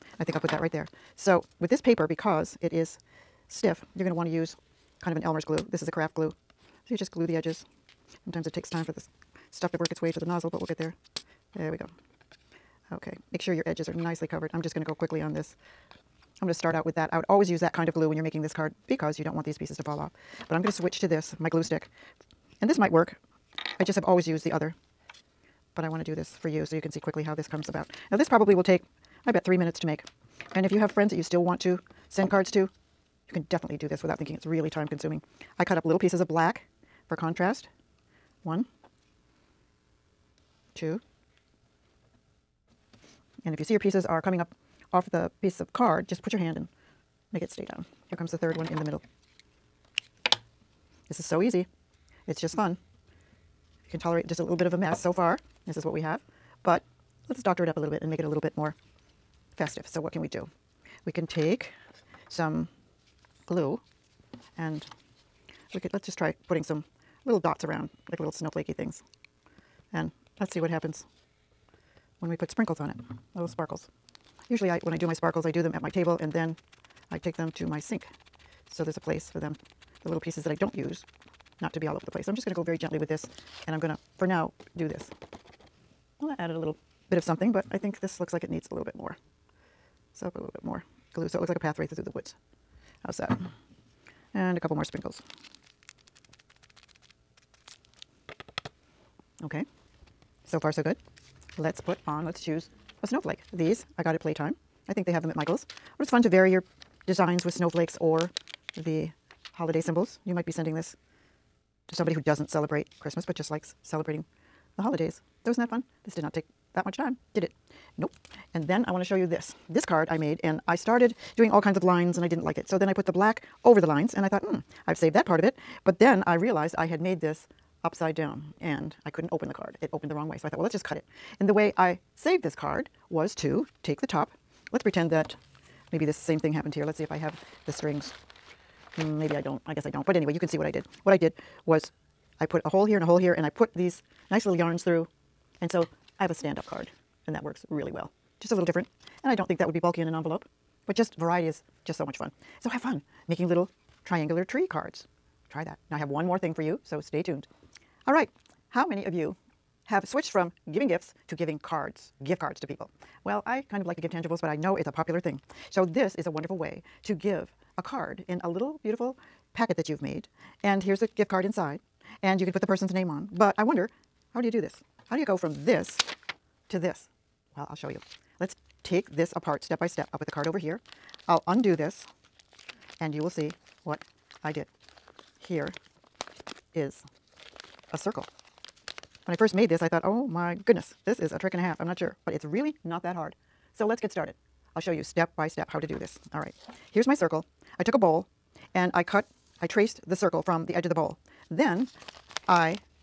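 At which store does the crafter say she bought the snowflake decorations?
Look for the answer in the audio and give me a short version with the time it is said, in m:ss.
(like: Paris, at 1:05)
Playtime, at 1:44.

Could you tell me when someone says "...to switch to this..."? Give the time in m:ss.
0:20.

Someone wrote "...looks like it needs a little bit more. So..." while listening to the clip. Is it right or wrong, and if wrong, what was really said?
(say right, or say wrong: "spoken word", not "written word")
right.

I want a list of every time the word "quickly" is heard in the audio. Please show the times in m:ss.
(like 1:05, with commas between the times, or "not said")
0:14, 0:26.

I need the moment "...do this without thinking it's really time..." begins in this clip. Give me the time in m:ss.
0:33.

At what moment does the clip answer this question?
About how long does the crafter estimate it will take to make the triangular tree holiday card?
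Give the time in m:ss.
0:29.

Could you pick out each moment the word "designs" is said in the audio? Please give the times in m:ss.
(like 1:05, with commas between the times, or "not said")
1:47.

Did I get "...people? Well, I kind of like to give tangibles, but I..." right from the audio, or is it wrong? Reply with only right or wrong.
right.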